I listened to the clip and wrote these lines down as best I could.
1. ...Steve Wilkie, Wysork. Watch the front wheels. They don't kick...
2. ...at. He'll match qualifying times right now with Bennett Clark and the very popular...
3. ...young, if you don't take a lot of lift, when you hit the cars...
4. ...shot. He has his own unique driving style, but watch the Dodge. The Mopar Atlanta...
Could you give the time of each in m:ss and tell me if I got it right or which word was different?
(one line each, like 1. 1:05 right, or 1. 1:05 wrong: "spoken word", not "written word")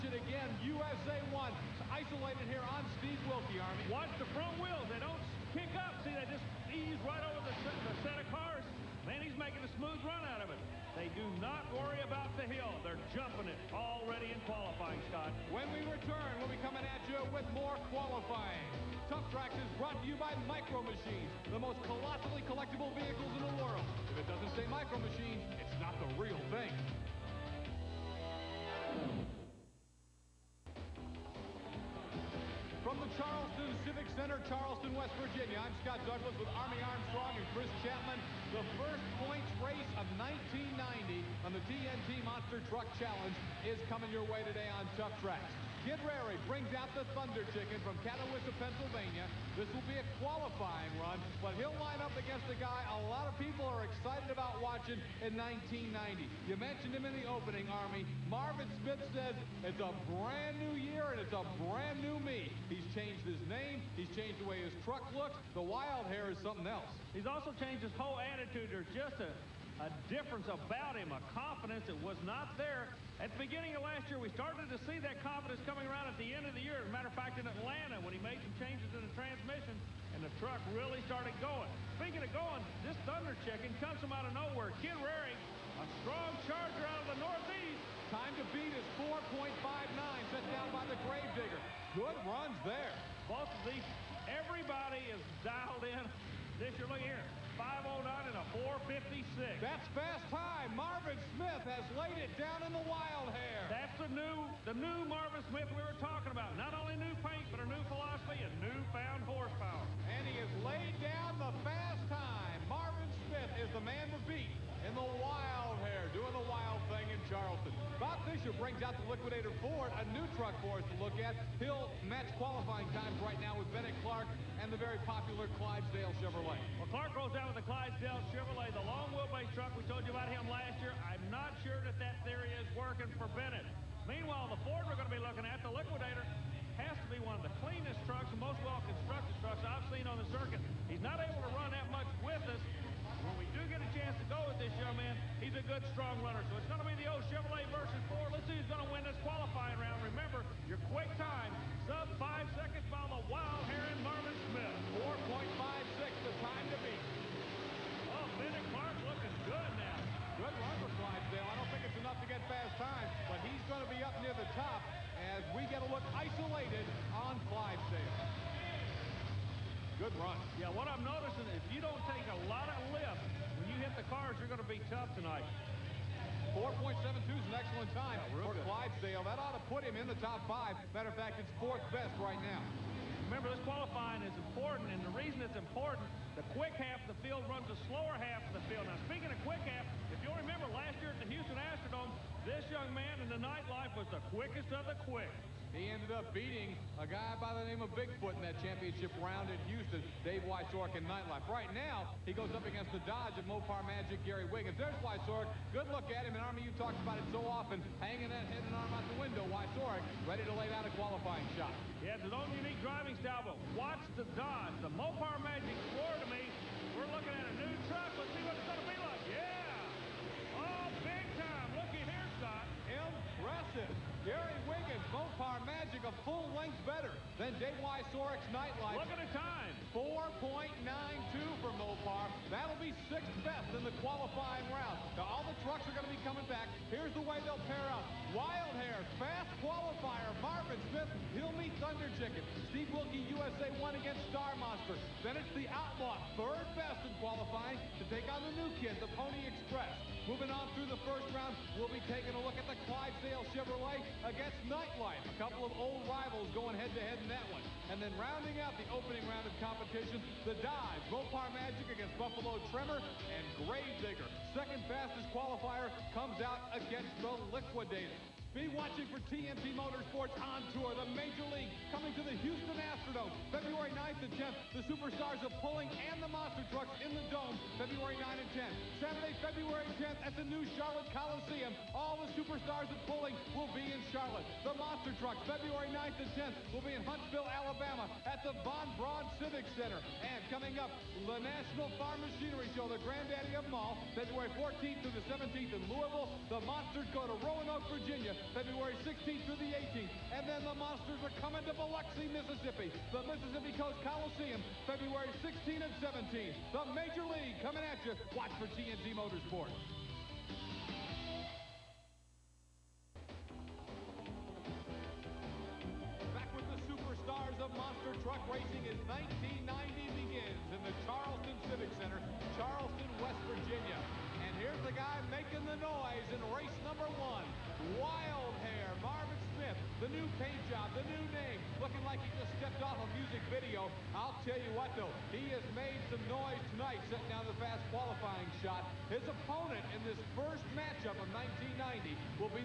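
1. 0:02 wrong: "Army", not "Wysork"
2. 2:01 right
3. 2:51 wrong: "noticing", not "young"
4. 3:31 wrong: "Magic", not "Atlanta".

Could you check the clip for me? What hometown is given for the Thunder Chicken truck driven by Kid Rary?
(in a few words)
Catawissa, Pennsylvania.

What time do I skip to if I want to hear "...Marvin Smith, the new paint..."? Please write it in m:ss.
5:29.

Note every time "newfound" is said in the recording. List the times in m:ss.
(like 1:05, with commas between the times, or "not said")
1:48.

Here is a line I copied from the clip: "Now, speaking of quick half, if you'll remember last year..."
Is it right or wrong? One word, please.
right.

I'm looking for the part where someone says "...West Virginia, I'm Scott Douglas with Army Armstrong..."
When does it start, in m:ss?
0:34.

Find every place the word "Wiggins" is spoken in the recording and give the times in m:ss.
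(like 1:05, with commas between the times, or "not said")
3:24, 3:44.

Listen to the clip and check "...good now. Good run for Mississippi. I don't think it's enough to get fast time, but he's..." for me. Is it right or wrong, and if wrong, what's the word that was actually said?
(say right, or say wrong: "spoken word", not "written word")
wrong: "Clydesdale", not "Mississippi".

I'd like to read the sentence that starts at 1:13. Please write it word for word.
At the beginning of last year, we started to see that confidence coming around at the end of the year.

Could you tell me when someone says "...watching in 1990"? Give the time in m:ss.
0:54.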